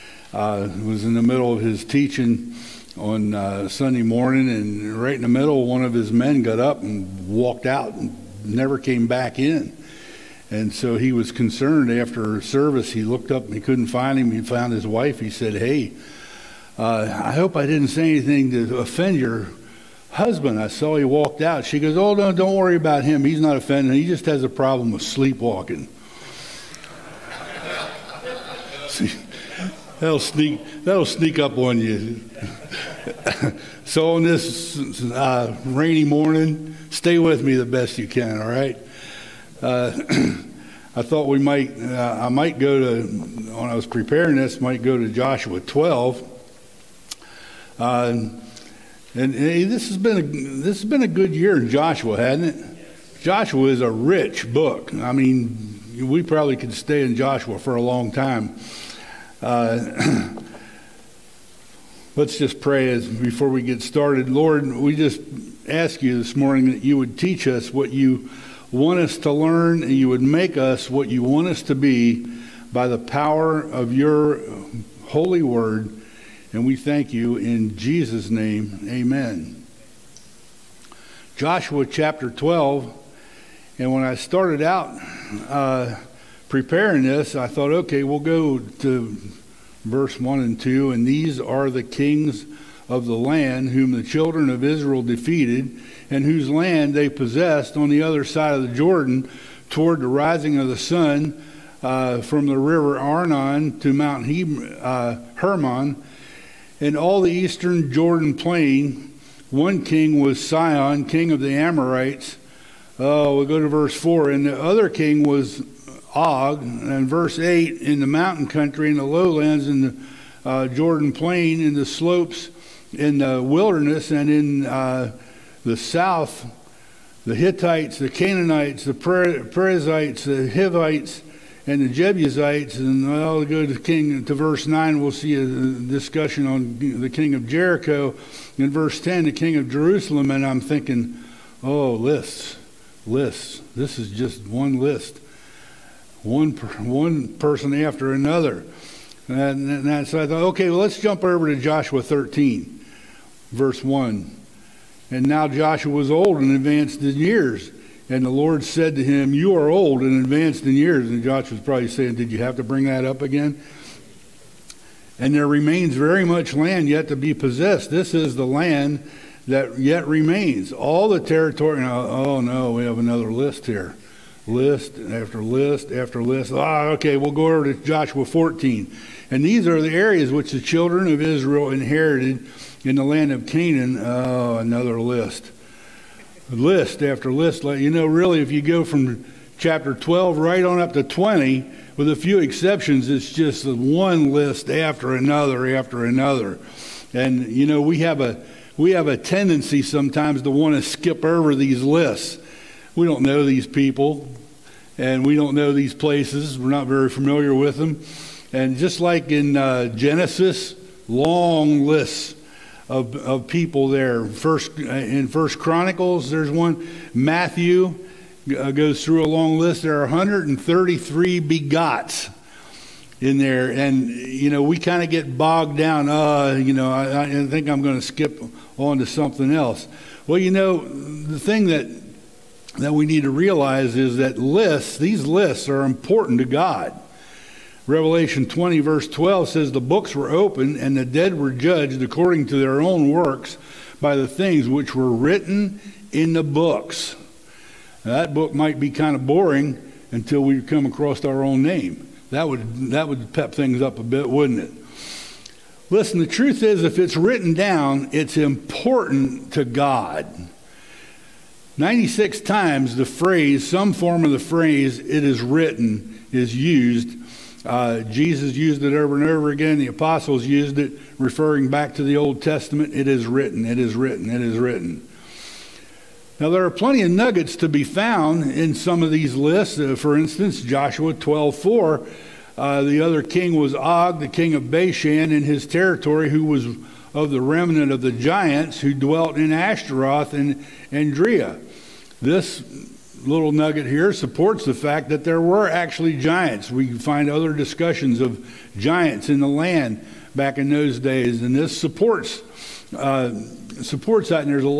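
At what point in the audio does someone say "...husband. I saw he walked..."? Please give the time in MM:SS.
00:20.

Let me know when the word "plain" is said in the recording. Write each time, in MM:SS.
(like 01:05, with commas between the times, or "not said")
01:48, 02:01.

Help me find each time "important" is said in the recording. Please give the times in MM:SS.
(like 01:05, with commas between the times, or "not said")
03:55, 04:18.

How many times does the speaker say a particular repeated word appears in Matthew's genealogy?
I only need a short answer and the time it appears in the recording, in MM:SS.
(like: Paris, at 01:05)
133, at 03:40.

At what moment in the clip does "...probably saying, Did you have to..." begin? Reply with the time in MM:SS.
02:41.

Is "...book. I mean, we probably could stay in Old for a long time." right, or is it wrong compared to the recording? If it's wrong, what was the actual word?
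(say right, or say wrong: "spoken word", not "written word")
wrong: "Joshua", not "Old".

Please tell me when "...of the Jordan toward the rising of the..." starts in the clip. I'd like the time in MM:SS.
01:38.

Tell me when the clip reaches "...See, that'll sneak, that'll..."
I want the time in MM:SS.
00:28.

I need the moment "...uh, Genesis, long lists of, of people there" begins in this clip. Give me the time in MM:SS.
03:29.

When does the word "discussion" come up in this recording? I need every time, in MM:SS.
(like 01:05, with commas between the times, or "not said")
02:15, 04:57.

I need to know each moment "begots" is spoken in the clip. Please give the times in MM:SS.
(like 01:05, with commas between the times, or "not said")
03:41.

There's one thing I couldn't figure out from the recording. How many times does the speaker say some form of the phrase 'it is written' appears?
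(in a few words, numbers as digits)
96.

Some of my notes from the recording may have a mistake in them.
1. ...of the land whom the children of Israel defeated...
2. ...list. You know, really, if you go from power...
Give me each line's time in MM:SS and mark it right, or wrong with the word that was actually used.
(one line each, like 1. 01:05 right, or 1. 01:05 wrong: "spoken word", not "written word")
1. 01:32 right
2. 03:07 wrong: "chapter", not "power".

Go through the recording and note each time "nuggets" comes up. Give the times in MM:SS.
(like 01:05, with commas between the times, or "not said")
04:37, 04:53.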